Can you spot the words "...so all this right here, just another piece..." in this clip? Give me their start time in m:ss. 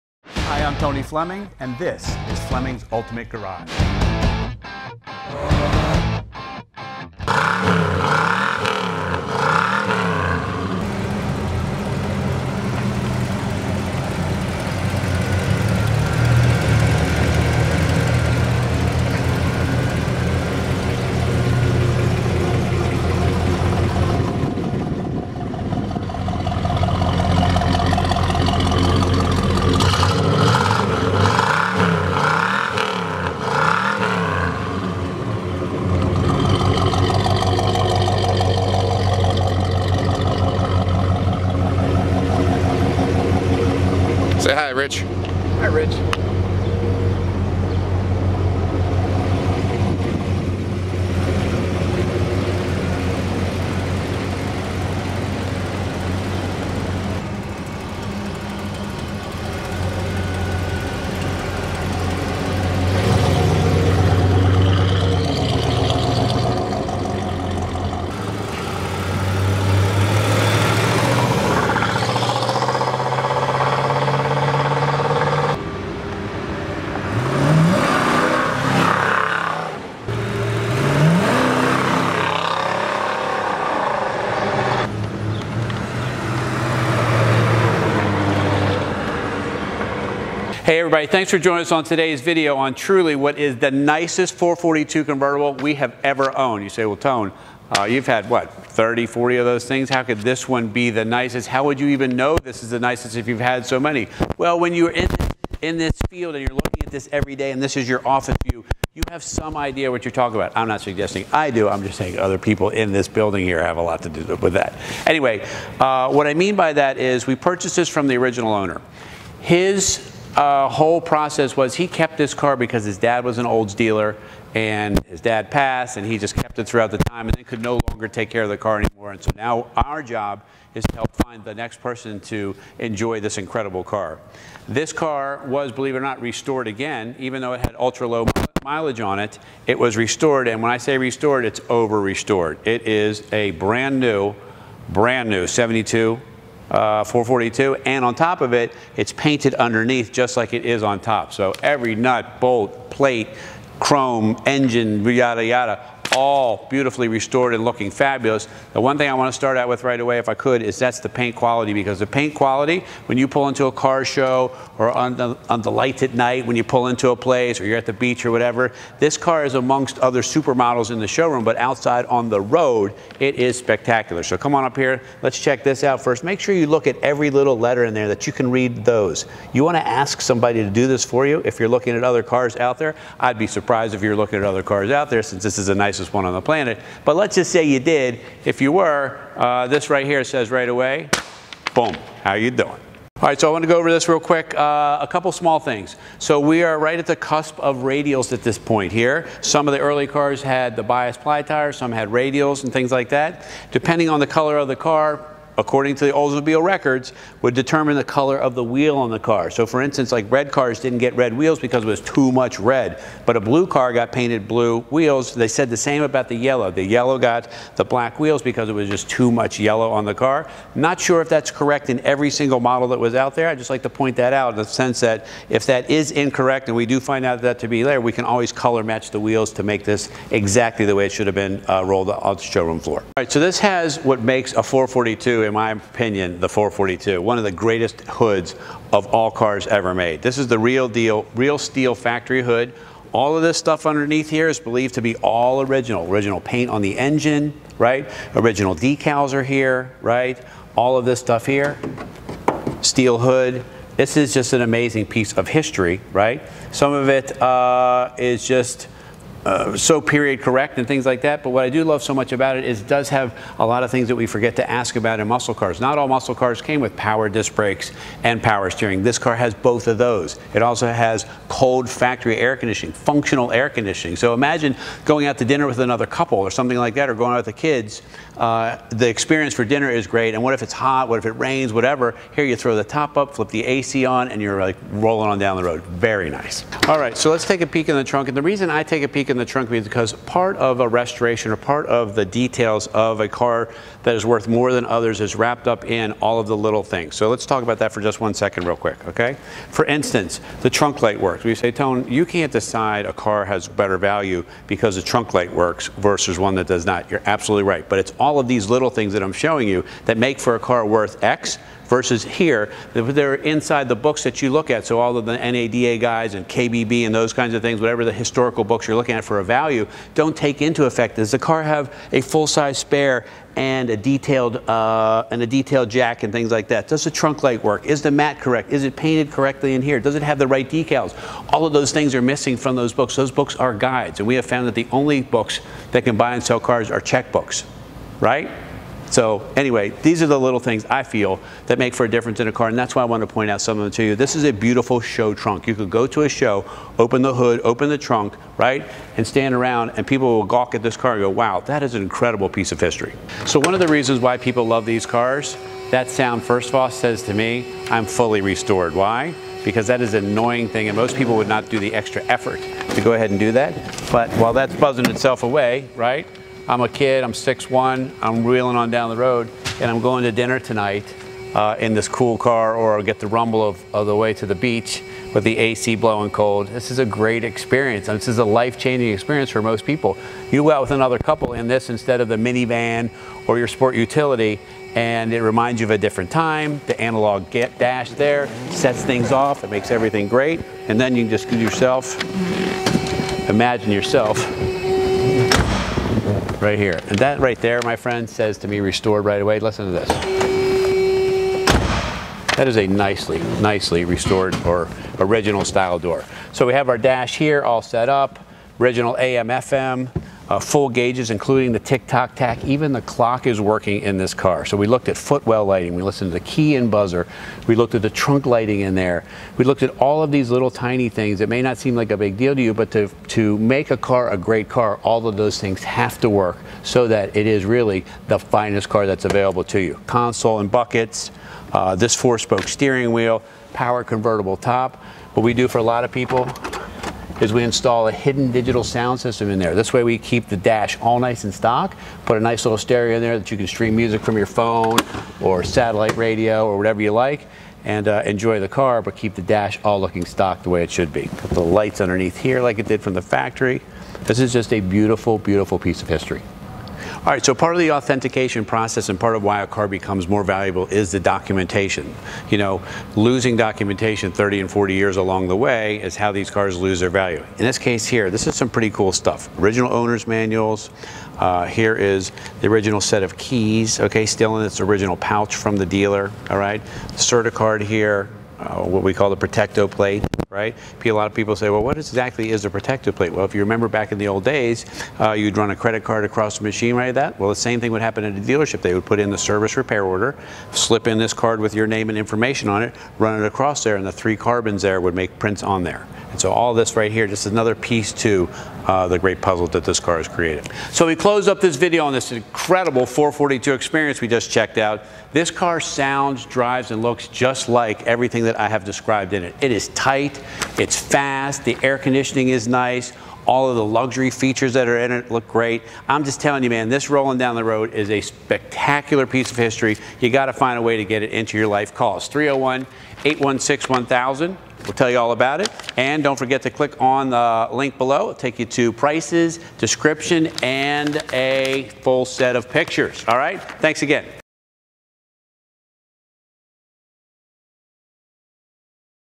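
8:16.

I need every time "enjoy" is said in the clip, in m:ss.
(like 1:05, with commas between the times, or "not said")
2:12, 7:28.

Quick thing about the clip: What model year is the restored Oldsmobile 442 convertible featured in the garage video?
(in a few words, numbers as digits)
72.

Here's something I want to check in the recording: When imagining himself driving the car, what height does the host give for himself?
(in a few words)
6'1".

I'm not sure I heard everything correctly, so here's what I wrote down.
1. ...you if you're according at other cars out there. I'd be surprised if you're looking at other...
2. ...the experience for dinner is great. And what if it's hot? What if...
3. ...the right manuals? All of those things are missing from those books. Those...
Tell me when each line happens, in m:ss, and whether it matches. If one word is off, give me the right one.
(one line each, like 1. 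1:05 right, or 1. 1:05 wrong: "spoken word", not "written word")
1. 3:01 wrong: "looking", not "according"
2. 4:38 right
3. 5:30 wrong: "decals", not "manuals".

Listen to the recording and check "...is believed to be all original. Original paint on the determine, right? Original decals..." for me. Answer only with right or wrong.
wrong.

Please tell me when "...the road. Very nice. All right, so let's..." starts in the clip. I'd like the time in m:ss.
4:45.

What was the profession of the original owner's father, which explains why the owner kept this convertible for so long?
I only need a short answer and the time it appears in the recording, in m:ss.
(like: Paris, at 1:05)
Olds dealer, at 2:03.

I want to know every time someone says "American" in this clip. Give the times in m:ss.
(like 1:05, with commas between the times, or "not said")
not said.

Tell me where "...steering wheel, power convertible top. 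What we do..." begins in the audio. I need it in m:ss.
7:12.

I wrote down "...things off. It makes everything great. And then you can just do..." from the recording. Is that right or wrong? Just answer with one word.
right.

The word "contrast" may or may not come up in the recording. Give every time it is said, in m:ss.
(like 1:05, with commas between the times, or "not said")
not said.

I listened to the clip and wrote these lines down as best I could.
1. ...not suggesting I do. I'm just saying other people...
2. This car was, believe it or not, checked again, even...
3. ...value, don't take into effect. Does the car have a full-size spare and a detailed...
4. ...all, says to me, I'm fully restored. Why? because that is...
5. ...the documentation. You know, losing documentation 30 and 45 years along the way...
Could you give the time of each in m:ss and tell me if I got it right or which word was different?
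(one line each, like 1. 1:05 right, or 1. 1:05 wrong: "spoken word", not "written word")
1. 1:50 right
2. 2:14 wrong: "restored", not "checked"
3. 5:19 right
4. 5:56 right
5. 7:41 wrong: "40", not "45".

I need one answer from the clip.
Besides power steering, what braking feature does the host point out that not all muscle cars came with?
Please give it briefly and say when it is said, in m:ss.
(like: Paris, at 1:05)
Power disc brakes, at 4:26.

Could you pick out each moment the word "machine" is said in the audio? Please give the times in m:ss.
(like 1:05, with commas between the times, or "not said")
8:06.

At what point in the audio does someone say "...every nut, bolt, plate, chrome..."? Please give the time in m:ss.
2:31.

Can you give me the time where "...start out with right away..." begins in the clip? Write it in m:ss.
2:39.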